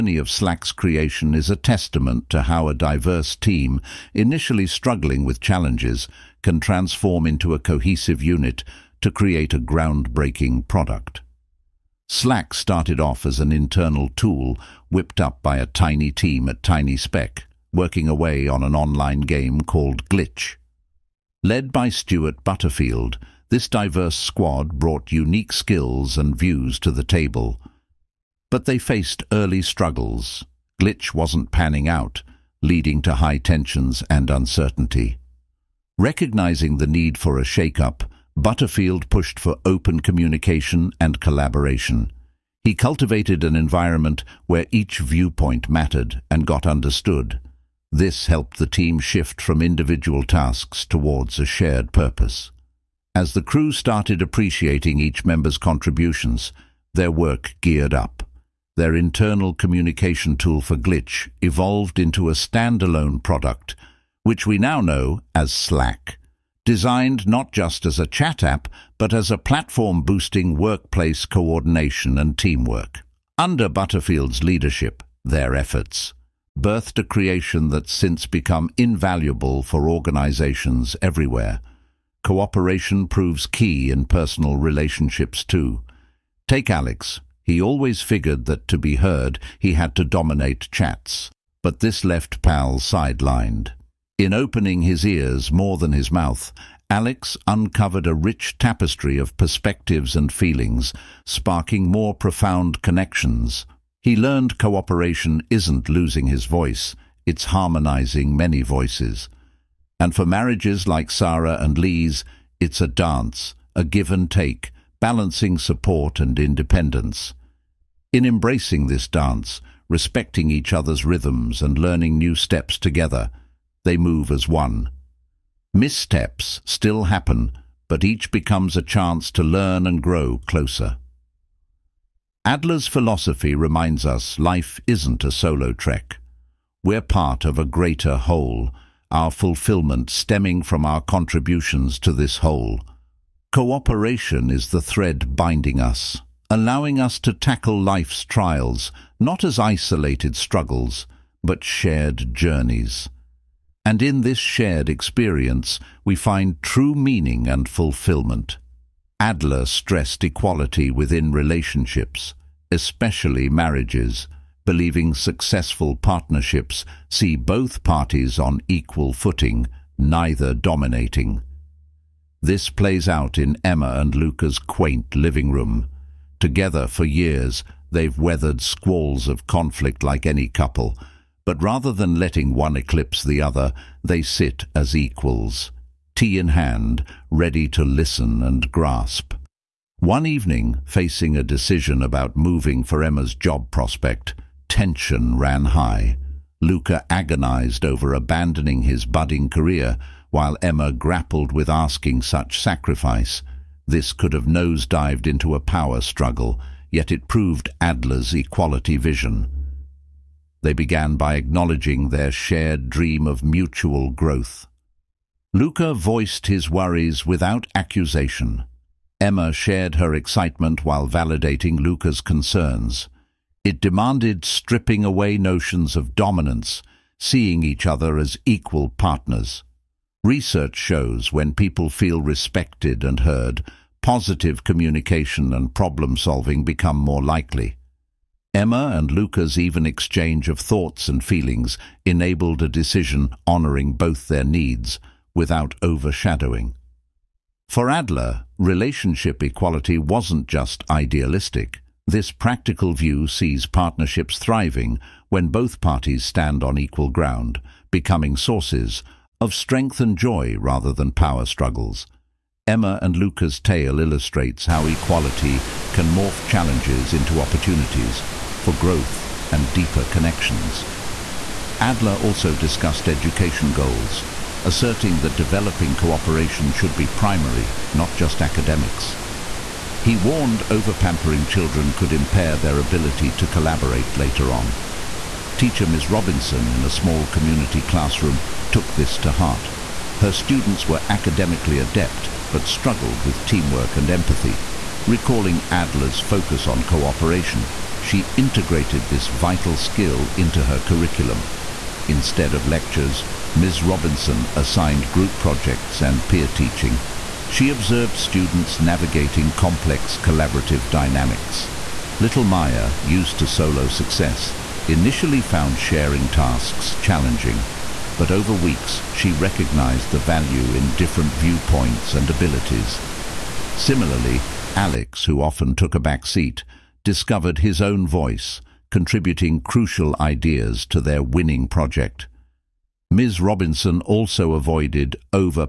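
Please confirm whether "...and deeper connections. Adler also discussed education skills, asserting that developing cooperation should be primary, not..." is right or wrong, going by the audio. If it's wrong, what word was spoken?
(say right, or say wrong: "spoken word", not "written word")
wrong: "goals", not "skills".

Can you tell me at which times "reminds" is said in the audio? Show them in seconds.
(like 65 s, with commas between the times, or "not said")
133 s.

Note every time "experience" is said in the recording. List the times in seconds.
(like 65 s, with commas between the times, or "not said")
154 s.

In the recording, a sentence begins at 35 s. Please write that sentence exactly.
Recognizing the need for a shake-up, Butterfield pushed for open communication and collaboration.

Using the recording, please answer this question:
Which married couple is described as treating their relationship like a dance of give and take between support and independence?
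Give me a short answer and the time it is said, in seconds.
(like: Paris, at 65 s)
Sarah and Lee, at 111 s.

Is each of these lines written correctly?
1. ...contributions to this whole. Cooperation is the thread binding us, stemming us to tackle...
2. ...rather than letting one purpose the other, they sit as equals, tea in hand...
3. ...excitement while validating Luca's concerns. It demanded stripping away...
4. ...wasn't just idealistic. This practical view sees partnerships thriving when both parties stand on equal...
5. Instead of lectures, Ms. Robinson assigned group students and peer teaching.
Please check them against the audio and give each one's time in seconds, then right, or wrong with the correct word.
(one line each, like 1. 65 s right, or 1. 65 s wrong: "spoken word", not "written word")
1. 141 s wrong: "allowing", not "stemming"
2. 181 s wrong: "eclipse", not "purpose"
3. 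220 s right
4. 249 s right
5. 302 s wrong: "projects", not "students".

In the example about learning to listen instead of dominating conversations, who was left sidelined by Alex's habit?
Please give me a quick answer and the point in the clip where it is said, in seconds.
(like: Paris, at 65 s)
Pal, at 92 s.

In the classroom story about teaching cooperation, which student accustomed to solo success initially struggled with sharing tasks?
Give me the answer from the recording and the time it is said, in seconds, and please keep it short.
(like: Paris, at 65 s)
Maya, at 312 s.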